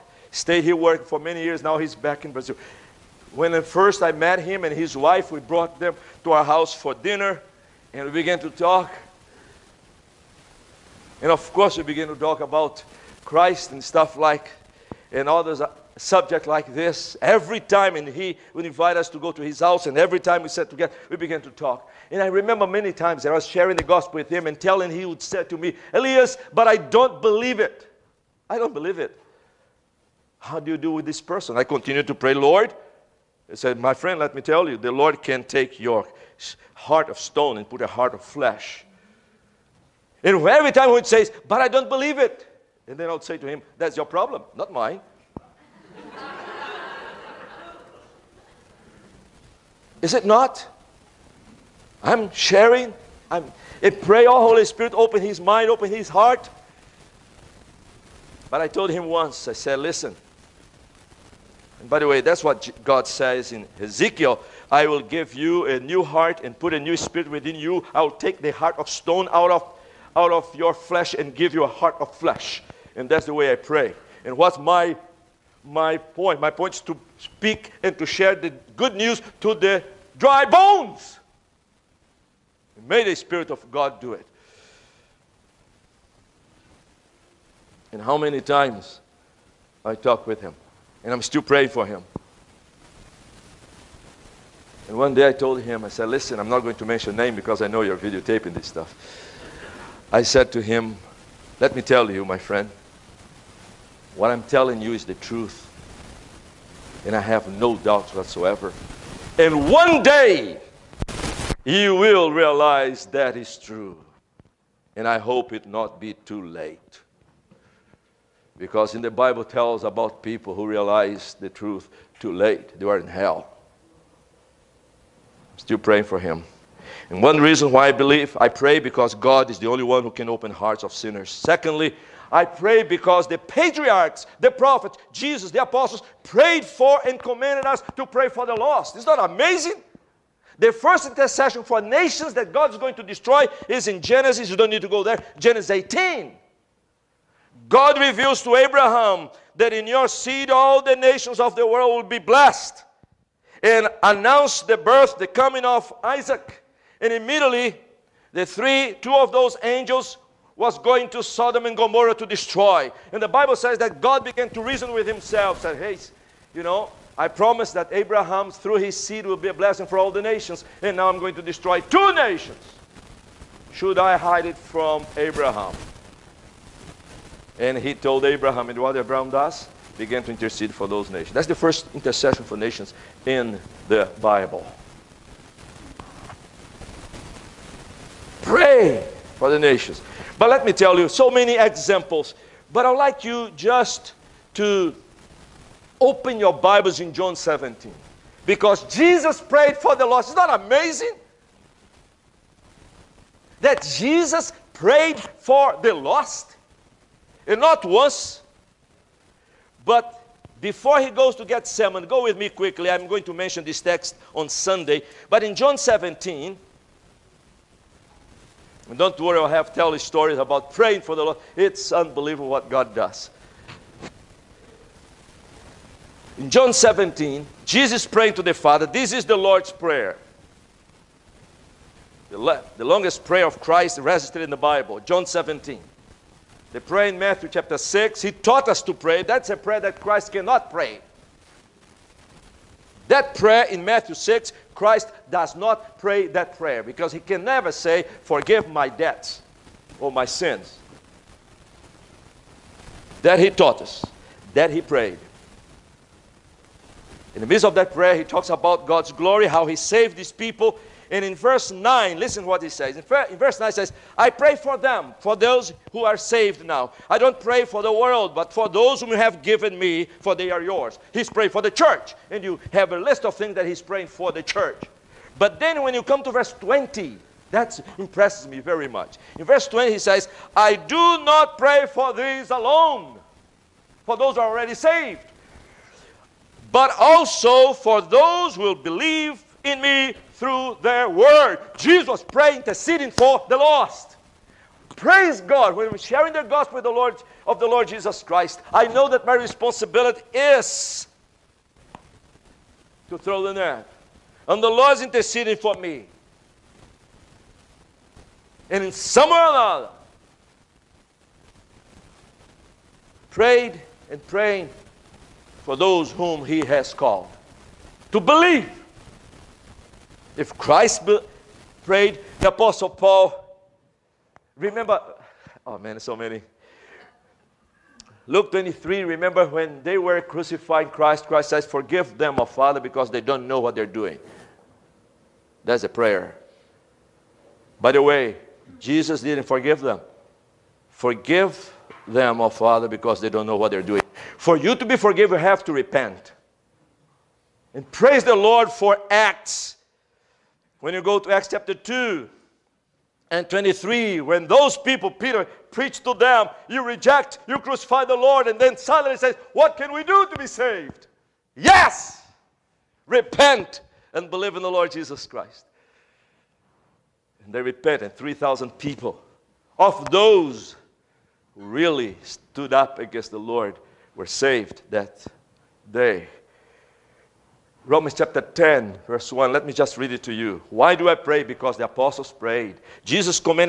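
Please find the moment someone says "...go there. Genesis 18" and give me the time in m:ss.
2:24.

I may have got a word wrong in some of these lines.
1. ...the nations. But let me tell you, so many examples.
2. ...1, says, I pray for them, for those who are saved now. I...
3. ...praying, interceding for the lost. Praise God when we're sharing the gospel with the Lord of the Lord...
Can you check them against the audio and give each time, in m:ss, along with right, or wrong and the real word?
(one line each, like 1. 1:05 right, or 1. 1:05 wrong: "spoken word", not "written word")
1. 3:09 right
2. 4:23 wrong: "9", not "1"
3. 4:52 right.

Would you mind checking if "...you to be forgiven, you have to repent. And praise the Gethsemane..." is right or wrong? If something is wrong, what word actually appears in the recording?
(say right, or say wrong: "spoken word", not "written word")
wrong: "Lord", not "Gethsemane".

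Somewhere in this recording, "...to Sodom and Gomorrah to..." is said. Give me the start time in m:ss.
2:41.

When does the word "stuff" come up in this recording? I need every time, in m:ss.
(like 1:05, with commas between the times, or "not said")
0:13, 1:38.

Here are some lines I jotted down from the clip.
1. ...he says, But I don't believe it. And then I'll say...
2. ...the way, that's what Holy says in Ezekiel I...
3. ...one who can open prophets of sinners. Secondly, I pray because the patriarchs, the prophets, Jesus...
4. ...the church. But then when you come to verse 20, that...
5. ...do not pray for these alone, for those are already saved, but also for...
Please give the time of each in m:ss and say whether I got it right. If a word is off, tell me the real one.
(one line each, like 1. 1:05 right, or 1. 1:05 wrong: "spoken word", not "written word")
1. 0:40 right
2. 1:01 wrong: "God", not "Holy"
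3. 2:09 wrong: "hearts", not "prophets"
4. 4:34 right
5. 4:40 right.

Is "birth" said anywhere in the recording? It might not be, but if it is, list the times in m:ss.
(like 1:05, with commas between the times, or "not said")
2:34.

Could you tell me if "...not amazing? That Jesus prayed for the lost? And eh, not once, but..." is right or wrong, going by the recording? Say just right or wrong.
right.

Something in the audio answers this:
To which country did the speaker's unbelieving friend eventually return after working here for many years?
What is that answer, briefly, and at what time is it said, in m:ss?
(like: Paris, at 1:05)
Brazil, at 0:02.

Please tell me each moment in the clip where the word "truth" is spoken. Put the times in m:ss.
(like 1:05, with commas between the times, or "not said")
1:45, 2:01.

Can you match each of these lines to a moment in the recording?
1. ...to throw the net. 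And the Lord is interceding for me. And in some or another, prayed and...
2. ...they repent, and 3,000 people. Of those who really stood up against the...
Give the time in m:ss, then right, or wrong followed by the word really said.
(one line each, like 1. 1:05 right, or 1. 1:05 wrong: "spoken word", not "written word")
1. 5:03 right
2. 6:07 right.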